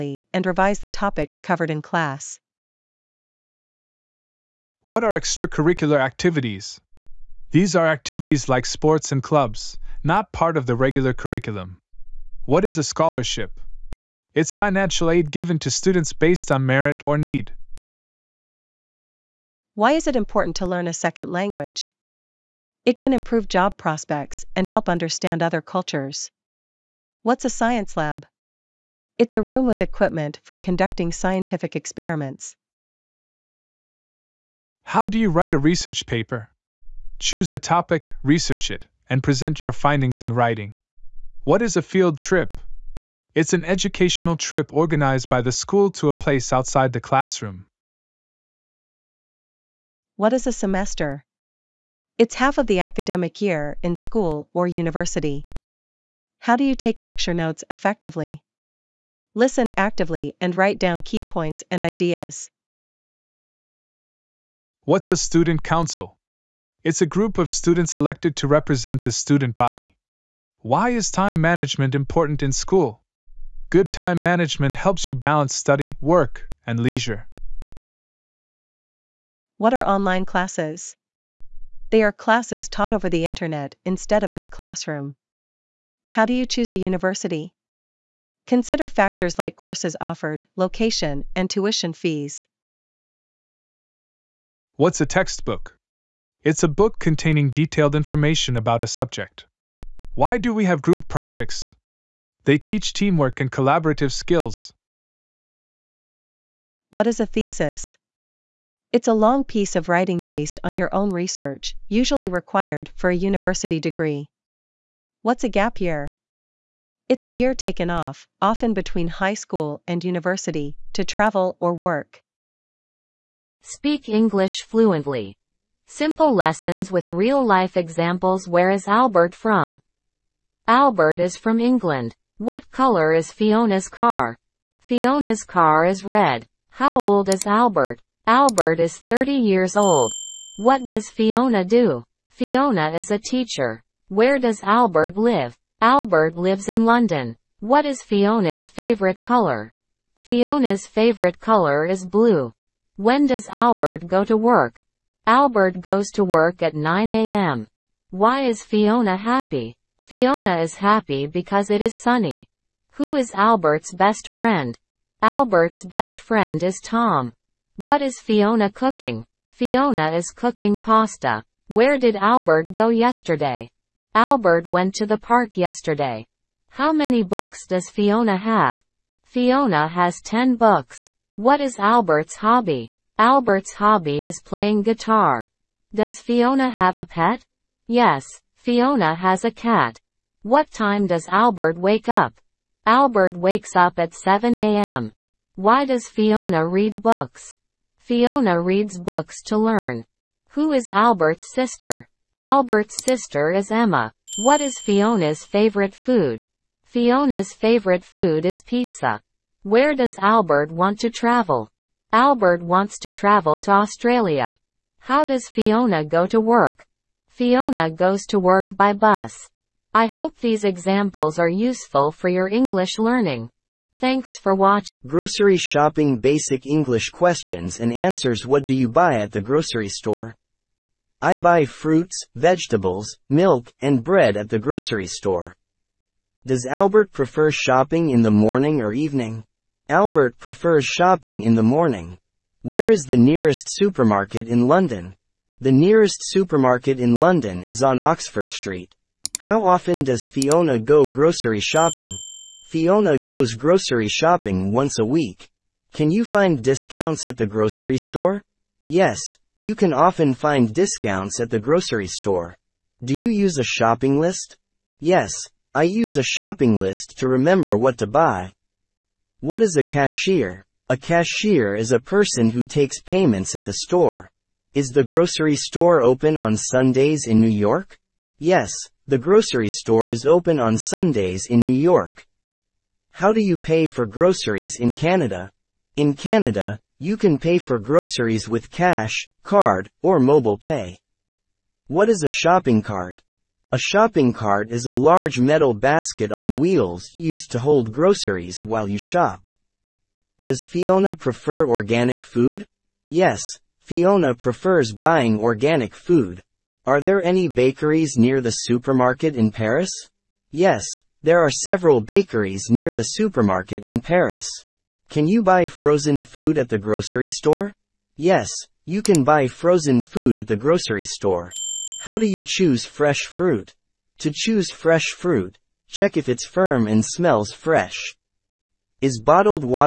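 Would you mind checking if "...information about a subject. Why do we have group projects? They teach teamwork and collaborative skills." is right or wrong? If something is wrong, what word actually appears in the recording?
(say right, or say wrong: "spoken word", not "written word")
right.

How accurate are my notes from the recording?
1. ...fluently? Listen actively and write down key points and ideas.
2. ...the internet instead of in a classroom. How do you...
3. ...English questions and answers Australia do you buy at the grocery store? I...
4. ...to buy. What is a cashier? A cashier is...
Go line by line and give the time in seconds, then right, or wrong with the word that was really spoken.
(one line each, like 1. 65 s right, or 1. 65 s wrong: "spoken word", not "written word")
1. 57 s wrong: "effectively", not "fluently"
2. 83 s right
3. 226 s wrong: "What", not "Australia"
4. 267 s right.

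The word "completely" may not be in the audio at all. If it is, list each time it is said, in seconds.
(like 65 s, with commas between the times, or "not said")
not said.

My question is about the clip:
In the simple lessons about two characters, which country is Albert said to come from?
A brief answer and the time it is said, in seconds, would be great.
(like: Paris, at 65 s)
England, at 131 s.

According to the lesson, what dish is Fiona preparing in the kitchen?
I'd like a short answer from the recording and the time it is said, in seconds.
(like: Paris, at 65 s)
Pasta, at 170 s.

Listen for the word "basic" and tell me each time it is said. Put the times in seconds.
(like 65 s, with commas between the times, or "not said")
226 s.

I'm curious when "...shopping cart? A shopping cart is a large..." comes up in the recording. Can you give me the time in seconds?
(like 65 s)
292 s.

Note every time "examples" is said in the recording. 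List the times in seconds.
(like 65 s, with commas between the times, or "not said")
127 s, 220 s.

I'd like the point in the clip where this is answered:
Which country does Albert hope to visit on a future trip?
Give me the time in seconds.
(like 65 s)
213 s.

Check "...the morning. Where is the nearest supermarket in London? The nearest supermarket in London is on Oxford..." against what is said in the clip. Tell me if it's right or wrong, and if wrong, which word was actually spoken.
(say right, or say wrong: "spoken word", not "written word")
right.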